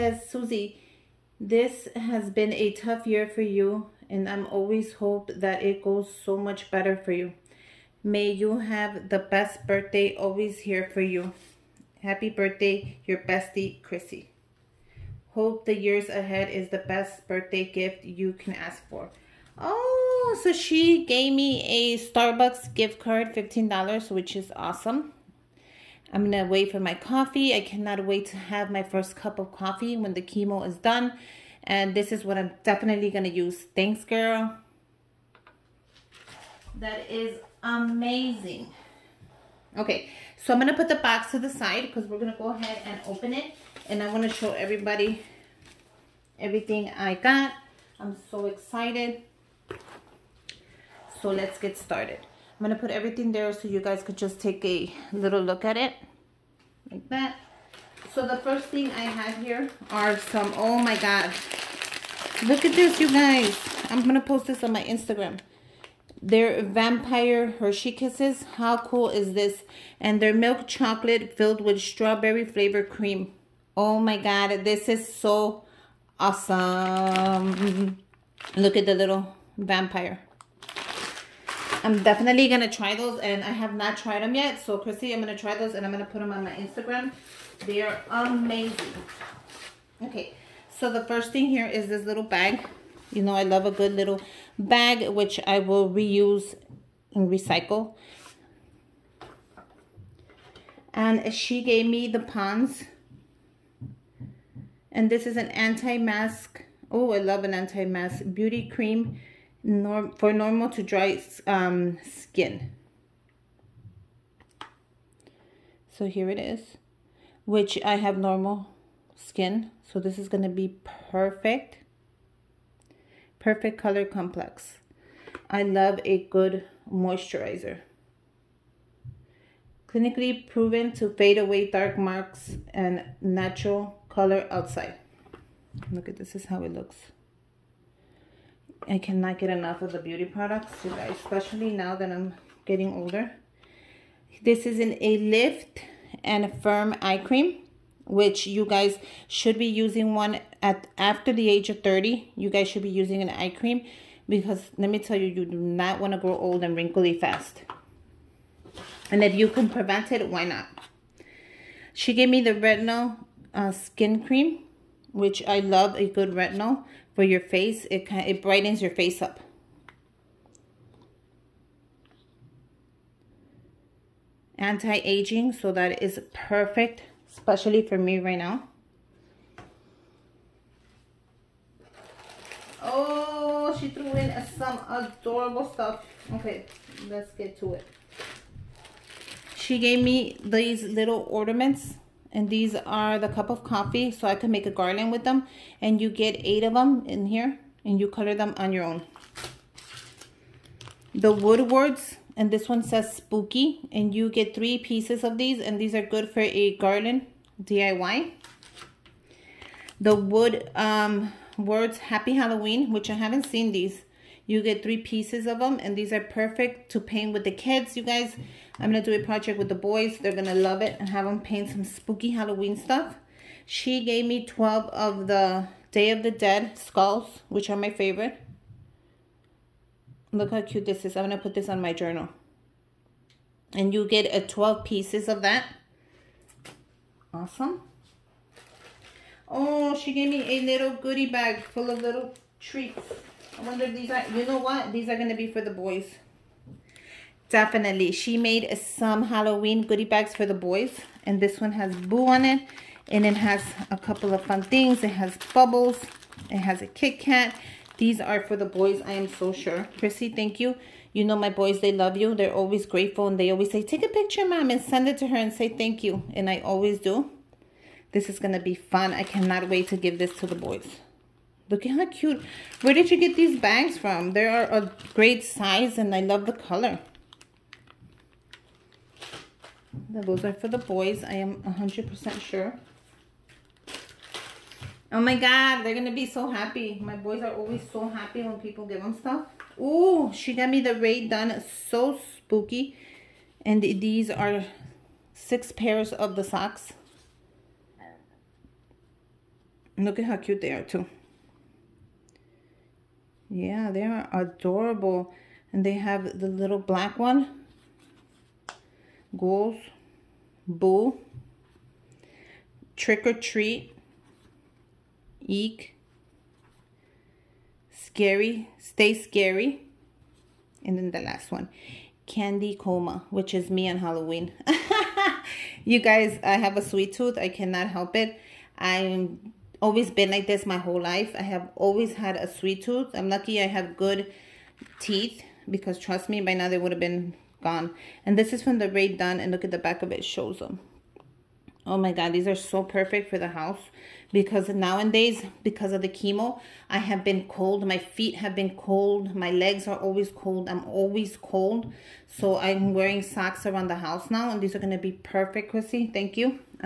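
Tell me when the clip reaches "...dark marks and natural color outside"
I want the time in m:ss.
2:11.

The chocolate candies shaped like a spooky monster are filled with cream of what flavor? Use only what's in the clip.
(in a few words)
Strawberry.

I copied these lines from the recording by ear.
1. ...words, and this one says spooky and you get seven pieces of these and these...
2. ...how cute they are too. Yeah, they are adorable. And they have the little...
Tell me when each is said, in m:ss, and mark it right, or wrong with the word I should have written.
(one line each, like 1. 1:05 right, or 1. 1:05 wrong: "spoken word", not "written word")
1. 3:21 wrong: "three", not "seven"
2. 5:00 right.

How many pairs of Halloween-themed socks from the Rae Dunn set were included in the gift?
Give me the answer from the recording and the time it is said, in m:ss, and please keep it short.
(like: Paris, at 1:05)
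6, at 4:55.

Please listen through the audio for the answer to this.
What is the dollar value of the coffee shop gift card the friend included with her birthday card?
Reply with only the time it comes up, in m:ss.
0:23.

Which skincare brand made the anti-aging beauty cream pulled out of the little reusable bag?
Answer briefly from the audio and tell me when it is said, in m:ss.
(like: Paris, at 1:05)
Pond's, at 1:42.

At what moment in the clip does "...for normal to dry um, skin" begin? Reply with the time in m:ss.
1:50.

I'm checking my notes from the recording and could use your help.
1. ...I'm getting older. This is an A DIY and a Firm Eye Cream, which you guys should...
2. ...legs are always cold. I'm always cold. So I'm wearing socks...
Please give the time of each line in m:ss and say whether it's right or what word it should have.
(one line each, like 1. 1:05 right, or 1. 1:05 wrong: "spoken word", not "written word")
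1. 2:22 wrong: "Lift", not "DIY"
2. 5:49 right.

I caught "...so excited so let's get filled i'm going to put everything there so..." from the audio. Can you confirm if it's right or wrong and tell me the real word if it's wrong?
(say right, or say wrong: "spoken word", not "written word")
wrong: "started", not "filled".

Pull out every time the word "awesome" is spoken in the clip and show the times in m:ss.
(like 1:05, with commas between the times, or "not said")
0:24, 1:16, 3:57.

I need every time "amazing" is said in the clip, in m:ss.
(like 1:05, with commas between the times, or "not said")
0:37, 1:28.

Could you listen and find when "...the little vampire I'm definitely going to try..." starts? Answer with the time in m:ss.
1:18.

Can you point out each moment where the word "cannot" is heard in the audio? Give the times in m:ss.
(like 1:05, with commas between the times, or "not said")
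0:27, 2:18, 4:29, 5:27.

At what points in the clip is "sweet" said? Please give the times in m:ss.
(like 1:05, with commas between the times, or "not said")
5:26, 5:32.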